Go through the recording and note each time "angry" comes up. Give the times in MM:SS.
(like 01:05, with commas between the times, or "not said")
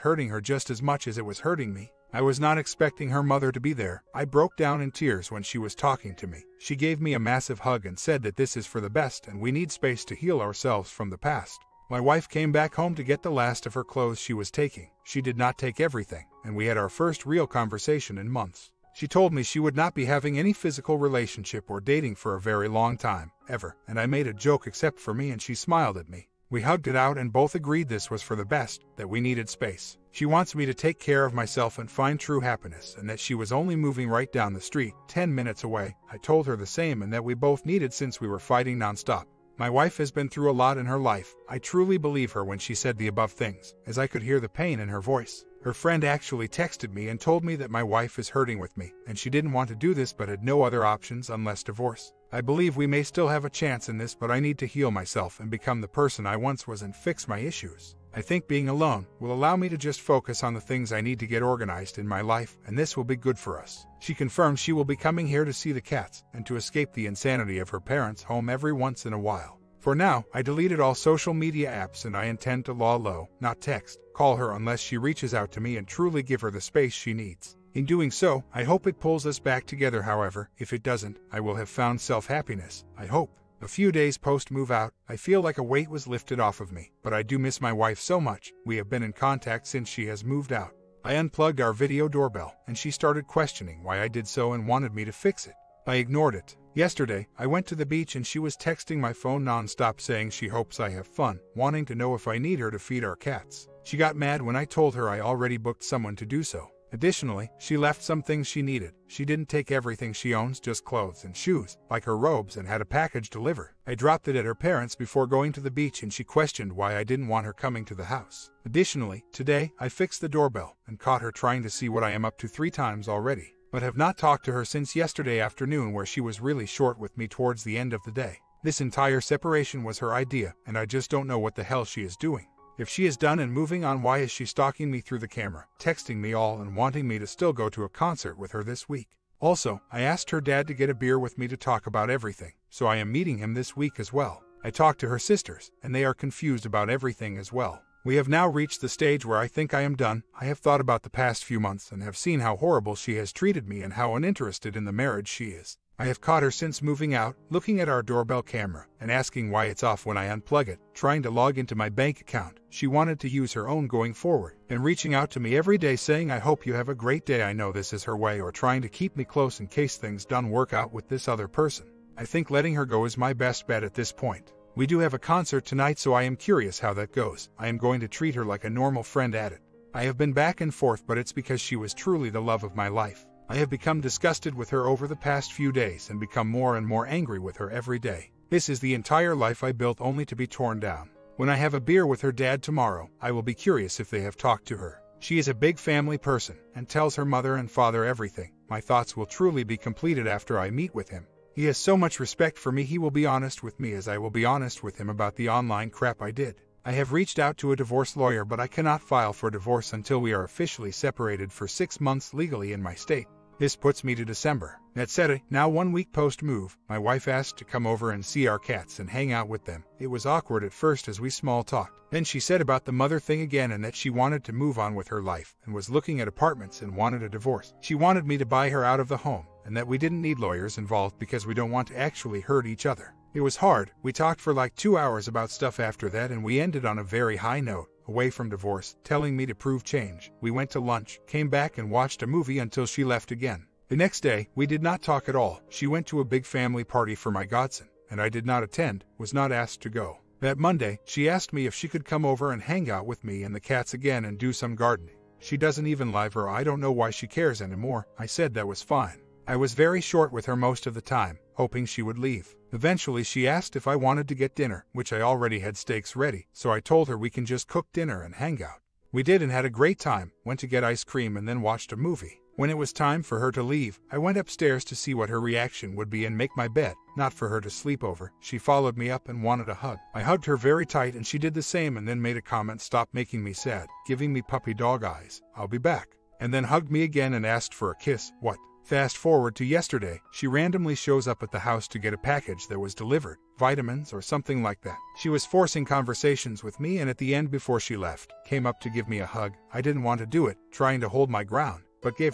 03:07.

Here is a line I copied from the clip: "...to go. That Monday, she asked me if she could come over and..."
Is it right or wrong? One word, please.
right.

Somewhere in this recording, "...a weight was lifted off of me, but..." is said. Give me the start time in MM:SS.
01:25.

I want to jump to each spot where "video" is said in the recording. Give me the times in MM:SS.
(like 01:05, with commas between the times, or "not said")
01:31.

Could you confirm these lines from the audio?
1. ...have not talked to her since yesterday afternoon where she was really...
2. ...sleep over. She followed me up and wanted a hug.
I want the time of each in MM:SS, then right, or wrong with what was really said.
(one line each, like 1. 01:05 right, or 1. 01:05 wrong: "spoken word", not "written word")
1. 02:03 right
2. 04:37 right.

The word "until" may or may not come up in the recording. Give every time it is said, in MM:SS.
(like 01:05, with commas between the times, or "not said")
03:29, 04:02.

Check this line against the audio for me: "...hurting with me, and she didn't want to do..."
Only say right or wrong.
right.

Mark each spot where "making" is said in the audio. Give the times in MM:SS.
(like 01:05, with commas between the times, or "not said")
04:43.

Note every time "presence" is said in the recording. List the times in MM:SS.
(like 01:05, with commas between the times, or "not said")
not said.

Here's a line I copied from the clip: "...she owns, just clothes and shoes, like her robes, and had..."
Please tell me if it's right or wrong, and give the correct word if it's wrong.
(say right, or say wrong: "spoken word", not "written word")
right.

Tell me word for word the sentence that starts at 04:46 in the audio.
And then hugged me again and asked for a kiss.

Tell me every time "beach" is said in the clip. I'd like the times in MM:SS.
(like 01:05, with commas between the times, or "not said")
01:37, 01:55.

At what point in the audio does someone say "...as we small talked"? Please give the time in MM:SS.
03:41.